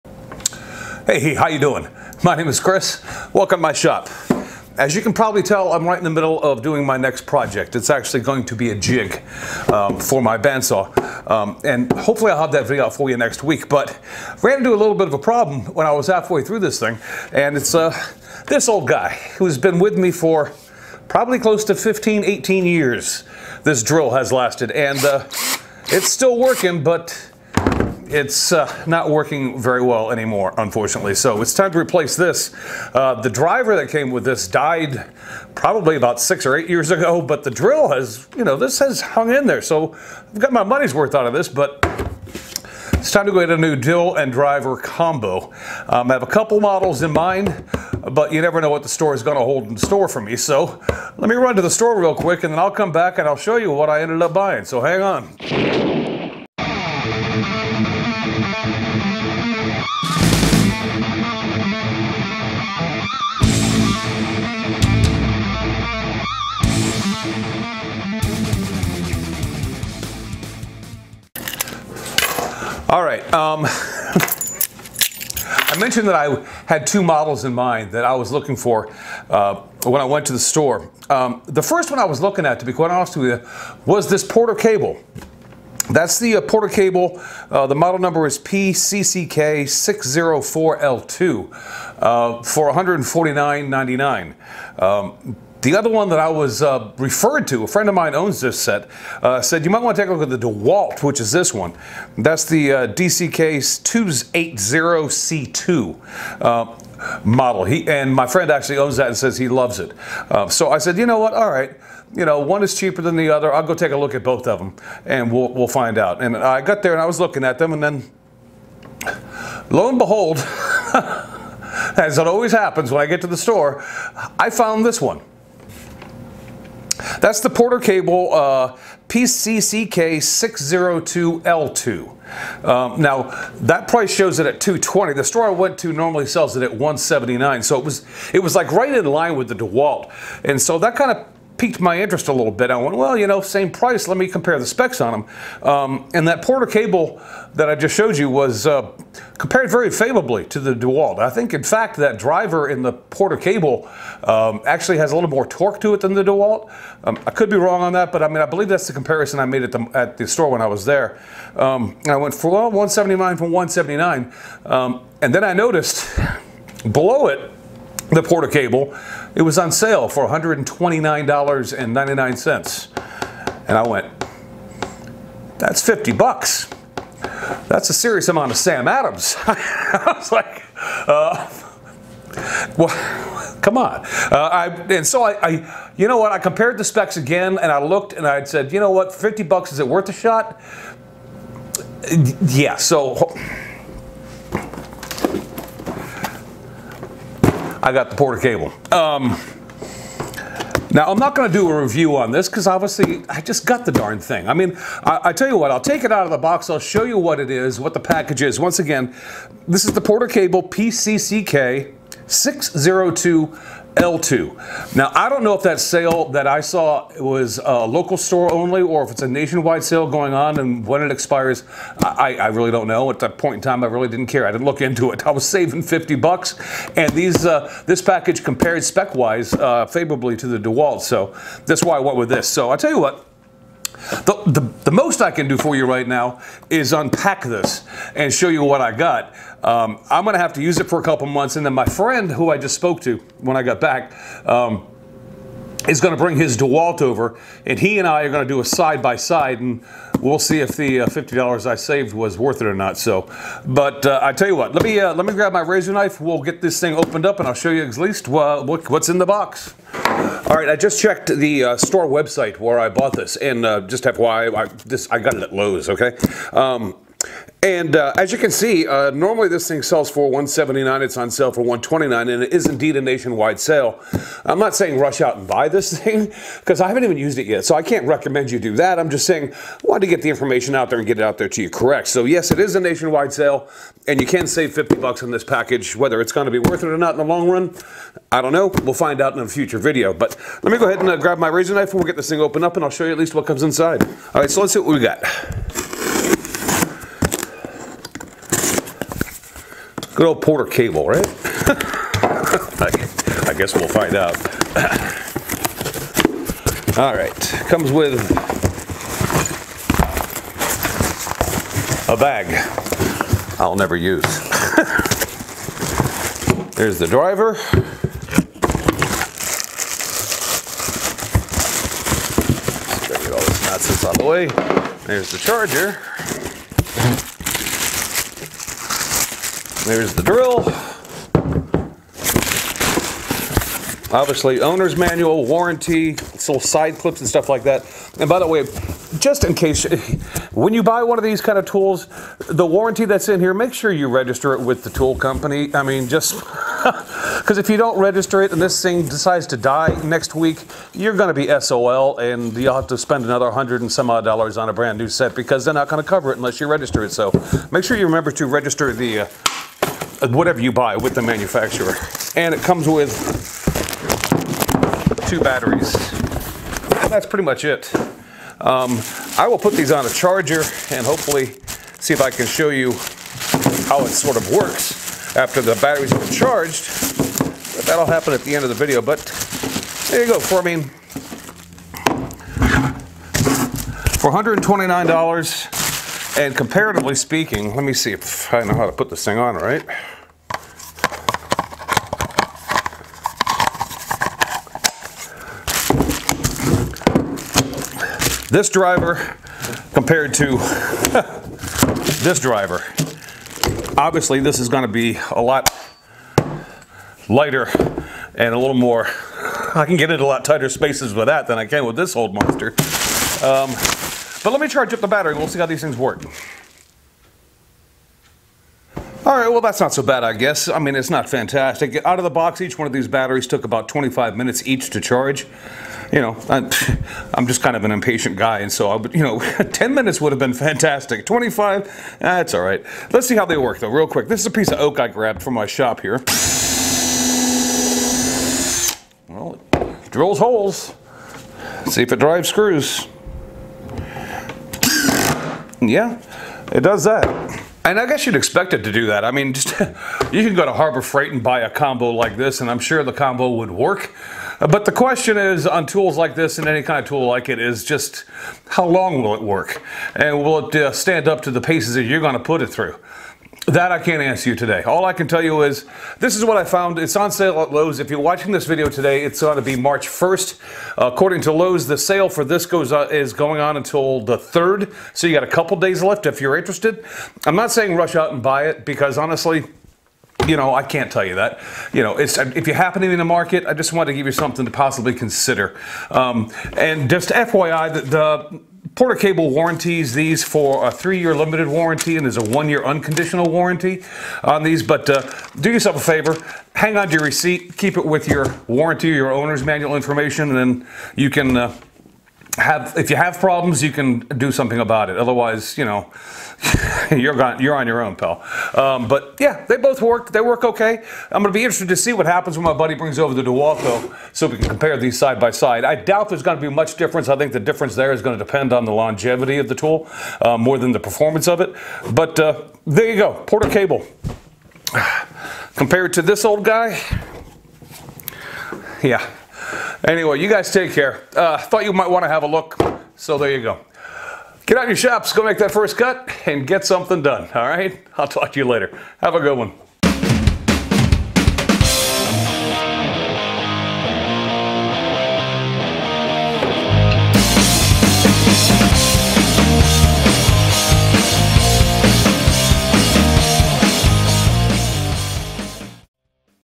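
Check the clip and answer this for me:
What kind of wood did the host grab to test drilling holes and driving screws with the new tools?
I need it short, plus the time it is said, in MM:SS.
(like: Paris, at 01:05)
Oak, at 07:14.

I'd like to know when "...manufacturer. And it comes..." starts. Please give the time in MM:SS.
06:01.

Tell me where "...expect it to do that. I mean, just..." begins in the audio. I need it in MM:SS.
07:28.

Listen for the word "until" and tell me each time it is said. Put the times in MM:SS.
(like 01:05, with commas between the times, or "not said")
07:53.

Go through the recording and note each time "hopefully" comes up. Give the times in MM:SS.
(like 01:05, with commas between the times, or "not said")
00:11, 06:11.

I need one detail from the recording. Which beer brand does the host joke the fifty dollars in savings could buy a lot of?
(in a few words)
Sam Adams.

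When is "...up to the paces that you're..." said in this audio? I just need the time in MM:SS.
07:41.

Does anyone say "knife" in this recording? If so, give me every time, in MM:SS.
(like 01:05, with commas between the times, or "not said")
04:15, 04:51.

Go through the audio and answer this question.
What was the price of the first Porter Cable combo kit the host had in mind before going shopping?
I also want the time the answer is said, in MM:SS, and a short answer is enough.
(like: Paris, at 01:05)
$149.99, at 01:32.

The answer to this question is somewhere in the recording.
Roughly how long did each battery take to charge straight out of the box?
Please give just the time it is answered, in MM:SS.
07:03.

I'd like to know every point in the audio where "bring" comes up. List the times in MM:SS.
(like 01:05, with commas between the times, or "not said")
04:06, 08:32.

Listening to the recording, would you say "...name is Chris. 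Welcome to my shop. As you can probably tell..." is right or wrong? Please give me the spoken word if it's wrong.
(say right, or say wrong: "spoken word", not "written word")
right.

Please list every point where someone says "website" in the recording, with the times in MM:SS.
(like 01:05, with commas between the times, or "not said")
04:22.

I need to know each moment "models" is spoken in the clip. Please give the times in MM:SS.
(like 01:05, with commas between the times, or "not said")
00:46, 01:17, 01:27, 01:47.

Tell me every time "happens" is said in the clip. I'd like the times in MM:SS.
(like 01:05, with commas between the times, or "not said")
02:02, 06:18, 08:02, 08:32.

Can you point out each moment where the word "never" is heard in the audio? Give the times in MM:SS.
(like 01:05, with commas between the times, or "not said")
00:48, 05:13.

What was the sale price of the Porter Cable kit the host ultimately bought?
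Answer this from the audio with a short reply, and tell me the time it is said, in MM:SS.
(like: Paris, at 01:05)
$129.99, at 02:50.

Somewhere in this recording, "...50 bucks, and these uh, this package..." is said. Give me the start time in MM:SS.
03:45.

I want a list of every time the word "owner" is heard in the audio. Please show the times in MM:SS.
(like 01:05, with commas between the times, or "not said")
05:34, 08:19.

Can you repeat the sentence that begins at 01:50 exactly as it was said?
Uh, so I said, you know what, all right.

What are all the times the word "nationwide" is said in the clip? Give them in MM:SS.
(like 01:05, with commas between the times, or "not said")
03:39, 04:33, 04:42.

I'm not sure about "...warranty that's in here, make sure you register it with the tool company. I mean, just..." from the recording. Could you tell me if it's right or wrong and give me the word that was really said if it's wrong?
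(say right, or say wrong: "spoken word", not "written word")
right.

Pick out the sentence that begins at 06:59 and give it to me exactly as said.
All right, well, that's not so bad, I guess.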